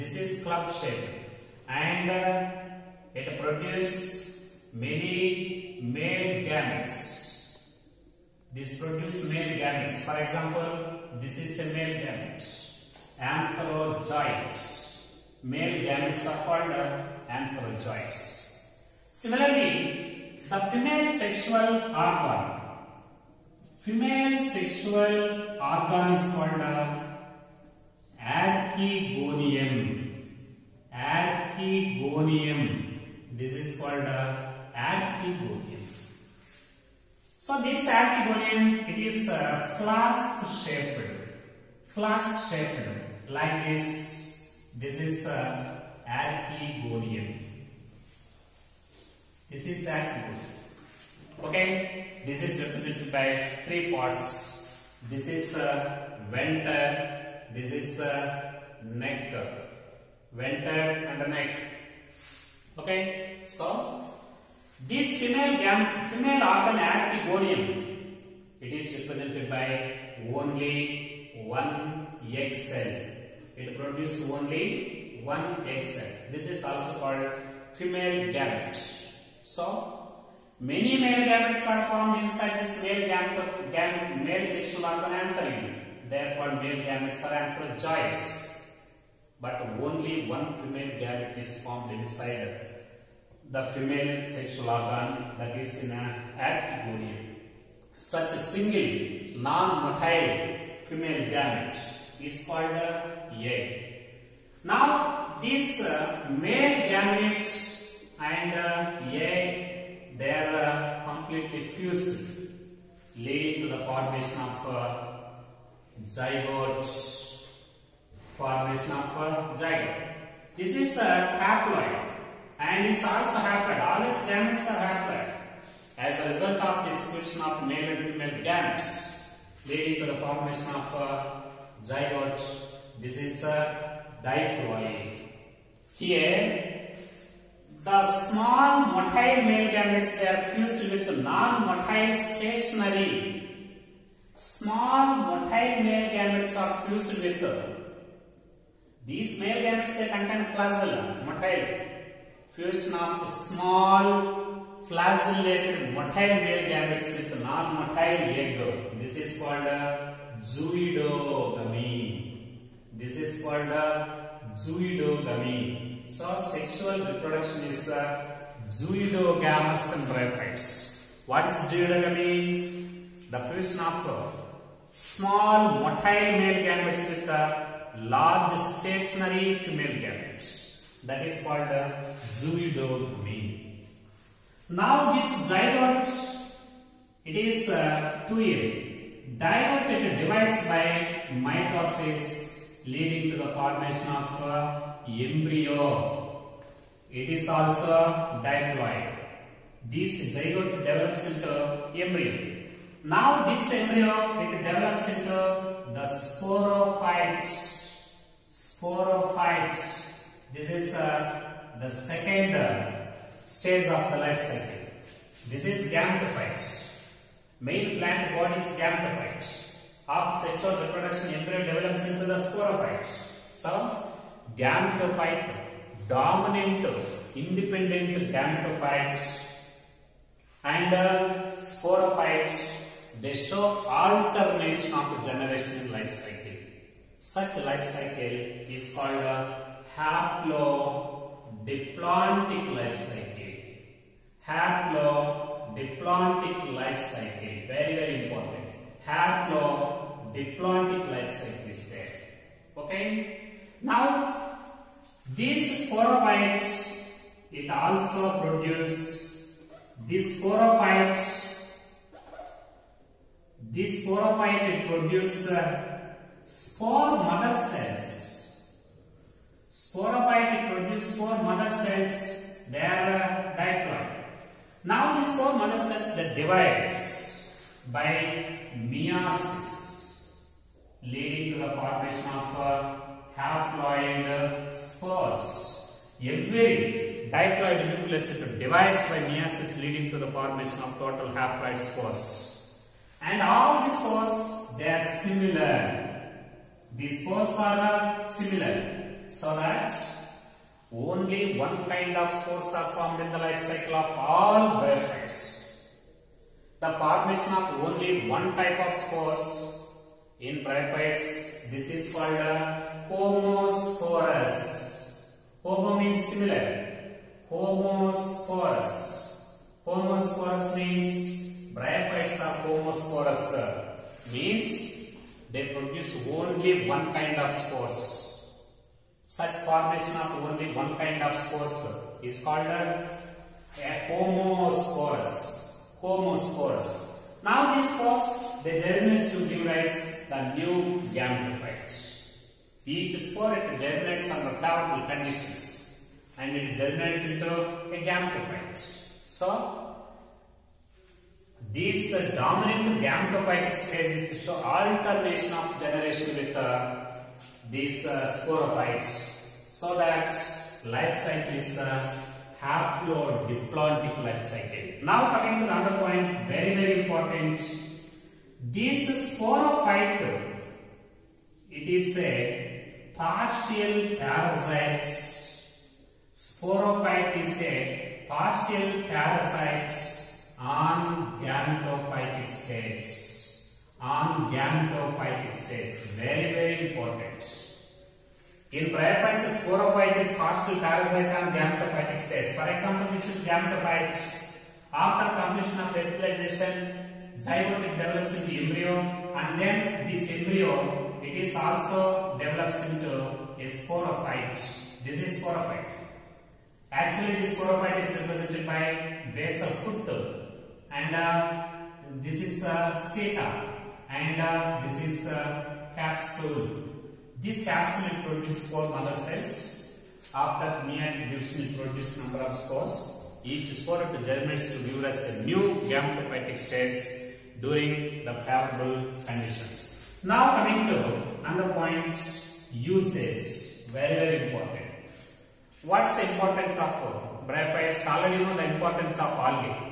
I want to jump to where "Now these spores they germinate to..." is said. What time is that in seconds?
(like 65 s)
337 s.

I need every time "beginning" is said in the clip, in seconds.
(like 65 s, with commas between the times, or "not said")
not said.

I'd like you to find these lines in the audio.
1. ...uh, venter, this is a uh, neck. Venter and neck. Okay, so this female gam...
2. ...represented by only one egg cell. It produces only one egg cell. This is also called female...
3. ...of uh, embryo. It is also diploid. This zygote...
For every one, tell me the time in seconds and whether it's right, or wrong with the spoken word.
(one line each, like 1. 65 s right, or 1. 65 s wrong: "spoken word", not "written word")
1. 56 s right
2. 68 s right
3. 194 s right.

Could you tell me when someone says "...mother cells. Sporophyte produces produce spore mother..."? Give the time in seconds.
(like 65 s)
267 s.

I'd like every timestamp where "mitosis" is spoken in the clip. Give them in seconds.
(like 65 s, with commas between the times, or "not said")
191 s.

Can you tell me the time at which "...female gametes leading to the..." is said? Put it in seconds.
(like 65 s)
128 s.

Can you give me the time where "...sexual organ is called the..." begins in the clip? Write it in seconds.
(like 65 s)
24 s.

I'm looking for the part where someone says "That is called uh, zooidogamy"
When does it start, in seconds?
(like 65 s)
181 s.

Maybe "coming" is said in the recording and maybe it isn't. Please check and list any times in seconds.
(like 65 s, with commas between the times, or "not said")
365 s, 430 s.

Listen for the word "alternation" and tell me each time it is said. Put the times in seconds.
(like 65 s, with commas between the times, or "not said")
233 s, 354 s.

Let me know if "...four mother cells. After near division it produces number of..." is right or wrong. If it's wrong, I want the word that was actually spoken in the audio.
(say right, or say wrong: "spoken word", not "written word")
right.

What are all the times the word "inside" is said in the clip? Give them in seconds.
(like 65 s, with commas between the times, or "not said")
82 s, 91 s.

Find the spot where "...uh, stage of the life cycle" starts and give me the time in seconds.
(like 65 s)
212 s.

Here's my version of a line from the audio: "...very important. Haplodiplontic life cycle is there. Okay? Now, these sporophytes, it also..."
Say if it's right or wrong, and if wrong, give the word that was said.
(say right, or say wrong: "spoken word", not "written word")
right.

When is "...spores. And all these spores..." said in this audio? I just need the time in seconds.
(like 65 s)
291 s.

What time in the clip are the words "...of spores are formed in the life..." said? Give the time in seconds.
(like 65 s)
302 s.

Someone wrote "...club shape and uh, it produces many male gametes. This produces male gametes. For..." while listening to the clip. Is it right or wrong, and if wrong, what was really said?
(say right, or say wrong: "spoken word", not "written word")
right.